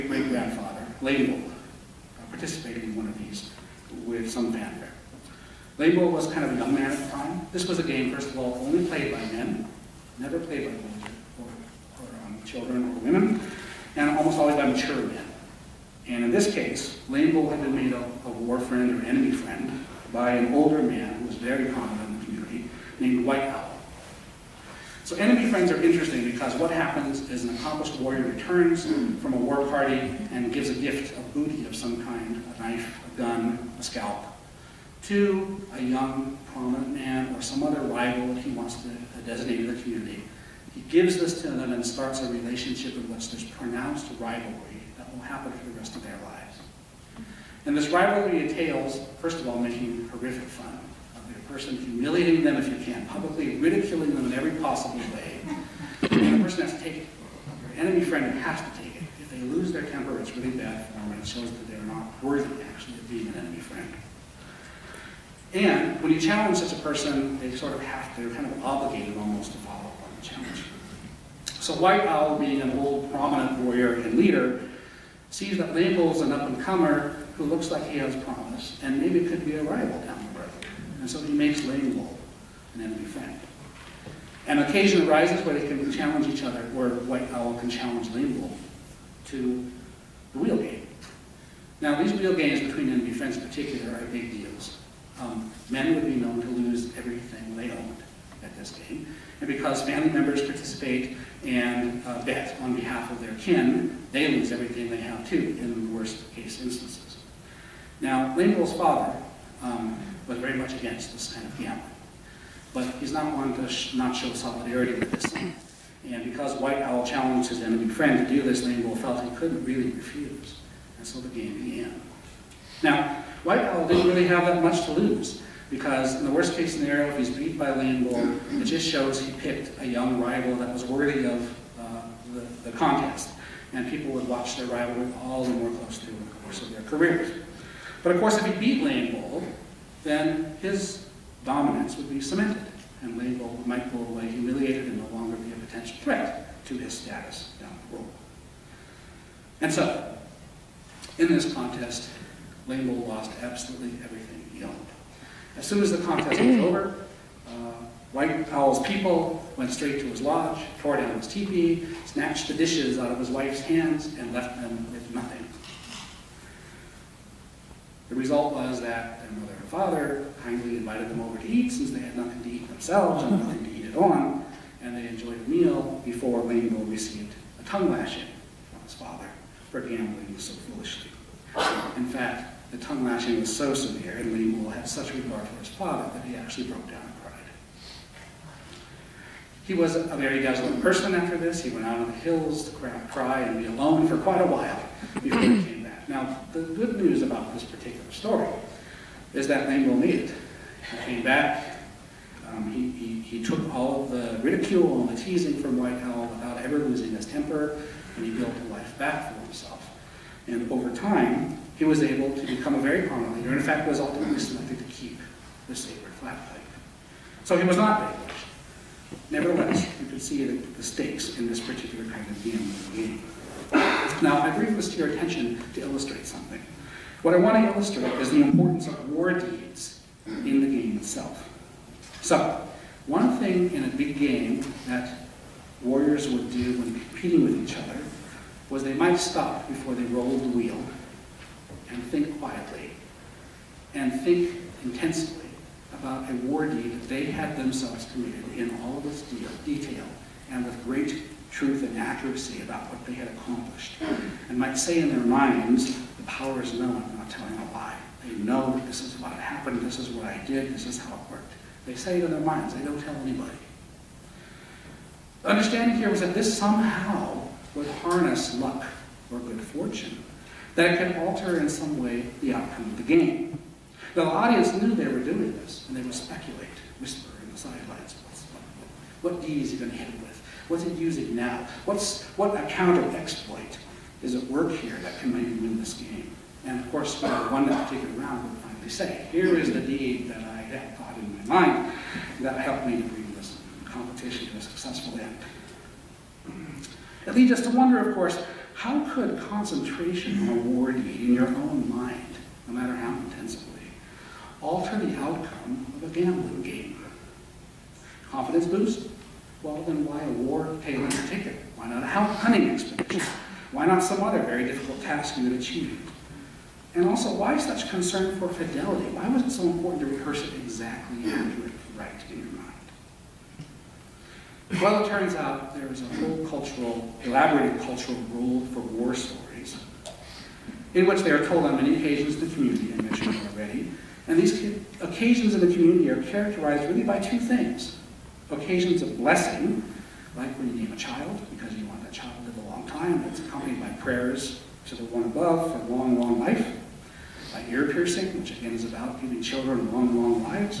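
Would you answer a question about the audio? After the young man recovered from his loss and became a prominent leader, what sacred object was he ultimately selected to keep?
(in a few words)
the sacred plate.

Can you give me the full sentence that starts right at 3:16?
Now, the good news about this particular story is that Lady Mole needed.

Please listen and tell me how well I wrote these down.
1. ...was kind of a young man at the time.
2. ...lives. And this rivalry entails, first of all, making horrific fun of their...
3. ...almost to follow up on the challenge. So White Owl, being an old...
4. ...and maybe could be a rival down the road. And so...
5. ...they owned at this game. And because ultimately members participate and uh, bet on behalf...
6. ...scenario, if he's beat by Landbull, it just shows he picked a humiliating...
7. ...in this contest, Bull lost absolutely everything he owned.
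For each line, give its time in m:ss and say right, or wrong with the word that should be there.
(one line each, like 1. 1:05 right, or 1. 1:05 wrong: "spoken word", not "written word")
1. 0:06 right
2. 0:46 right
3. 1:09 right
4. 1:18 right
5. 1:37 wrong: "family", not "ultimately"
6. 2:06 wrong: "young", not "humiliating"
7. 2:31 wrong: "Lambo", not "Bull".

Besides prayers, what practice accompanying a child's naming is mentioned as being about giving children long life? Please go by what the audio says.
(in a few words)
ear piercing.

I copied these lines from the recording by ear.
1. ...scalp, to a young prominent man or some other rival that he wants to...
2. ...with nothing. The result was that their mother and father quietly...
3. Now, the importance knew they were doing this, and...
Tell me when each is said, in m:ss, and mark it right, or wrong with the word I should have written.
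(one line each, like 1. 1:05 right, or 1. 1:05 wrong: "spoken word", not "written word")
1. 0:33 right
2. 2:44 wrong: "kindly", not "quietly"
3. 4:34 wrong: "audience", not "importance".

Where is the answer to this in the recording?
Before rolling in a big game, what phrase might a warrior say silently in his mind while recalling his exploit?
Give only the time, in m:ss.
4:16.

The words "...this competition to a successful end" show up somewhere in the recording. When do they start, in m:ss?
4:53.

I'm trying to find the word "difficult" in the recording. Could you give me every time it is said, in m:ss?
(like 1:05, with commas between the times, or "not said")
5:14.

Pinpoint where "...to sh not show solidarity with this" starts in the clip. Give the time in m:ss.
1:53.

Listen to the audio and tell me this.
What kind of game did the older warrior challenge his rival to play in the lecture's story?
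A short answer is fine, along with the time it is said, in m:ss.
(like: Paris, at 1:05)
the wheel game, at 1:30.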